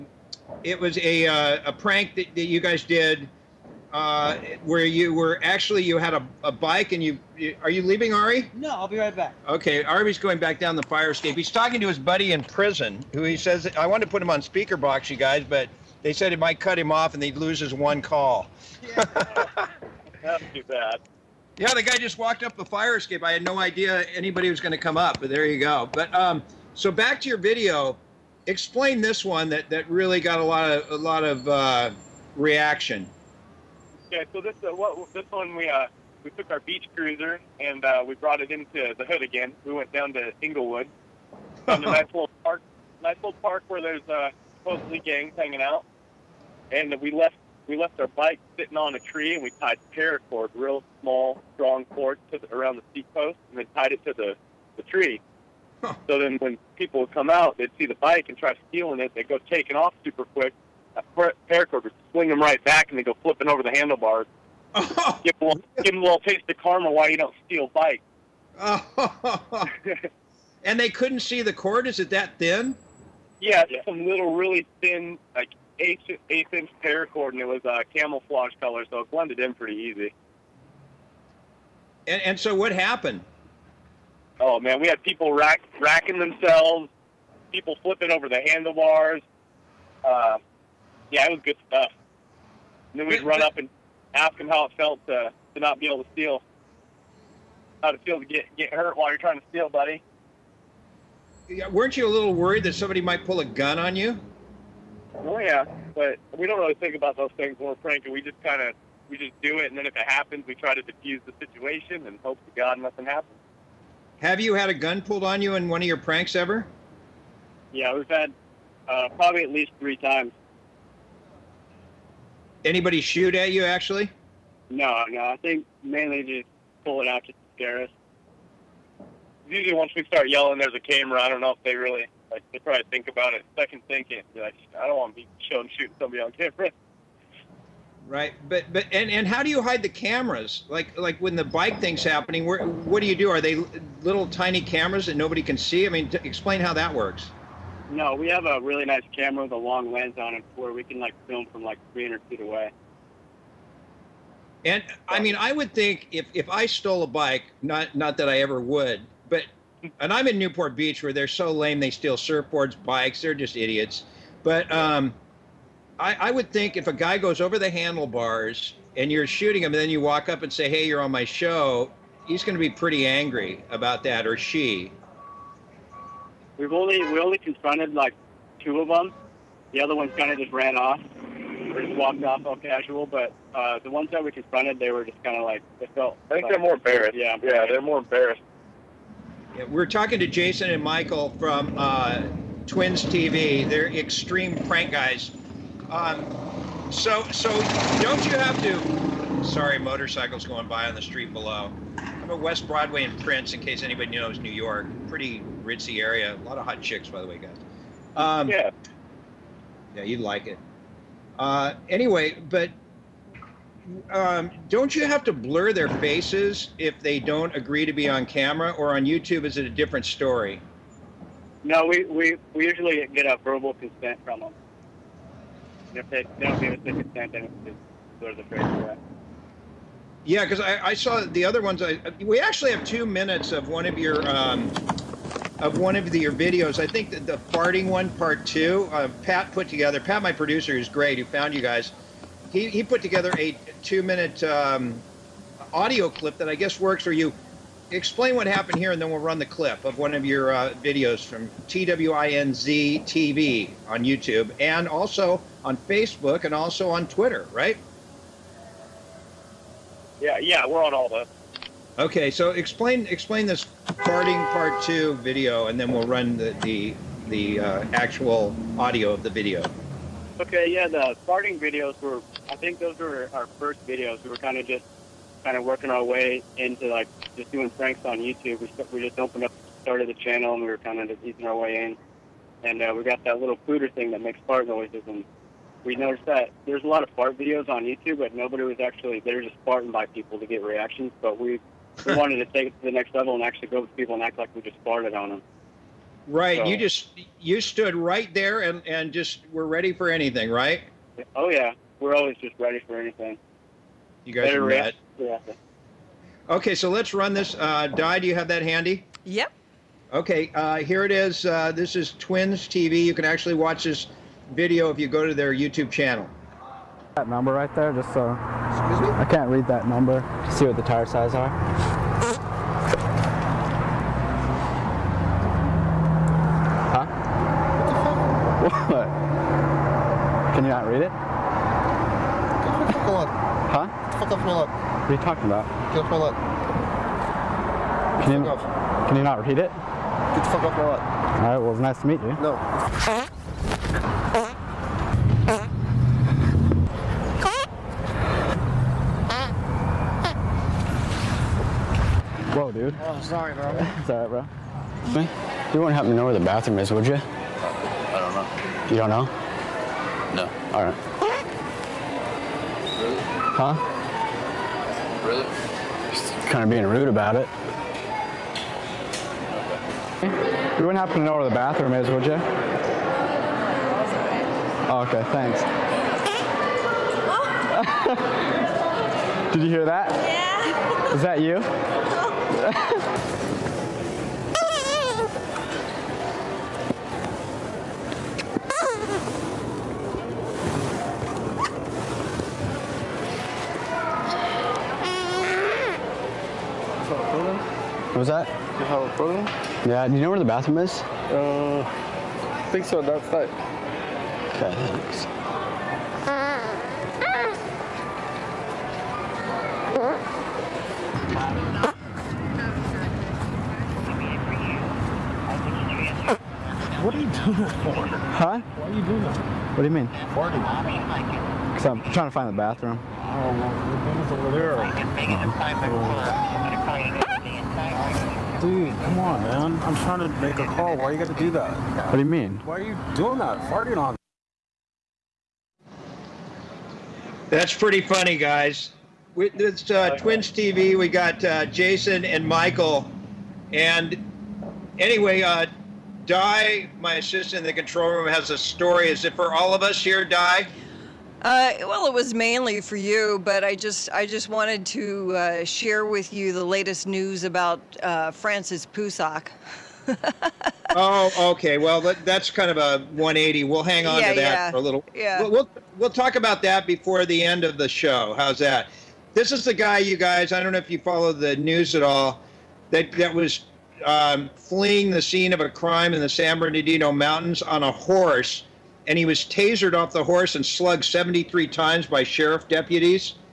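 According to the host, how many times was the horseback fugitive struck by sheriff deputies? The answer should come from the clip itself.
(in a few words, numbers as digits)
73.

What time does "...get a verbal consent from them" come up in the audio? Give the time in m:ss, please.
3:43.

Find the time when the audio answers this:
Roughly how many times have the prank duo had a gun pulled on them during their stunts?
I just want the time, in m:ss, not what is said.
1:59.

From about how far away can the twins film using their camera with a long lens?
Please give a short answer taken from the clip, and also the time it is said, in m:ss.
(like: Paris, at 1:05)
300 feet, at 2:31.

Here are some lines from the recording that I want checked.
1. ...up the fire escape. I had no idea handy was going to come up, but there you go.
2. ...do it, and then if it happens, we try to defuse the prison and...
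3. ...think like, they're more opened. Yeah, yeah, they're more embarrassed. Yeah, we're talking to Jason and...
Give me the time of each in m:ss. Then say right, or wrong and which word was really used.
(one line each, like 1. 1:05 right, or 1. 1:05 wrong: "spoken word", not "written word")
1. 0:22 wrong: "anybody", not "handy"
2. 1:49 wrong: "situation", not "prison"
3. 3:06 wrong: "embarrassed", not "opened".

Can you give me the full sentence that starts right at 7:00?
Because I'm trying to find the bathroom.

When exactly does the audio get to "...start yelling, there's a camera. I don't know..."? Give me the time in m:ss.
2:10.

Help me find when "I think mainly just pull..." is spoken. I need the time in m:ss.
2:05.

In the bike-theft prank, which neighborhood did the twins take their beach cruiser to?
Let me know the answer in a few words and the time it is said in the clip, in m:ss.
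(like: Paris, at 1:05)
Inglewood, at 0:40.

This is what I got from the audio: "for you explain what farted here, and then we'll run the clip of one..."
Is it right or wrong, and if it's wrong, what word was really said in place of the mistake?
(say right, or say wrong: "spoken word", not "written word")
wrong: "happened", not "farted".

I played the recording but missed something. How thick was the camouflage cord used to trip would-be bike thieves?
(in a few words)
eighth inch.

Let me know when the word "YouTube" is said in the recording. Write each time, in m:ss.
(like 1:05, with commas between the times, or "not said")
3:39, 4:14, 4:38, 4:47, 5:15.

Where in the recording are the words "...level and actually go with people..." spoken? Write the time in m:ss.
4:53.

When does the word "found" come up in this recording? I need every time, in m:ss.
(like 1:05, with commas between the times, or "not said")
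0:41, 4:01.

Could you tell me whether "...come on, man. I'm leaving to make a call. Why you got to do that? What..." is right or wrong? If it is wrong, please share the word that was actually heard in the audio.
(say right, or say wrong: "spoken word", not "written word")
wrong: "trying", not "leaving".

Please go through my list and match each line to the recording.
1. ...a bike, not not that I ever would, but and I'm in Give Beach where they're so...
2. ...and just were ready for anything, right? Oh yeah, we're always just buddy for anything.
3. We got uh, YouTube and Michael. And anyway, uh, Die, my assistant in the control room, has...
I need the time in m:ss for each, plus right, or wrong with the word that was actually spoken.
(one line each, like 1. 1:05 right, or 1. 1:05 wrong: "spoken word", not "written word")
1. 2:37 wrong: "Newport", not "Give"
2. 4:58 wrong: "ready", not "buddy"
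3. 7:20 wrong: "Jason", not "YouTube".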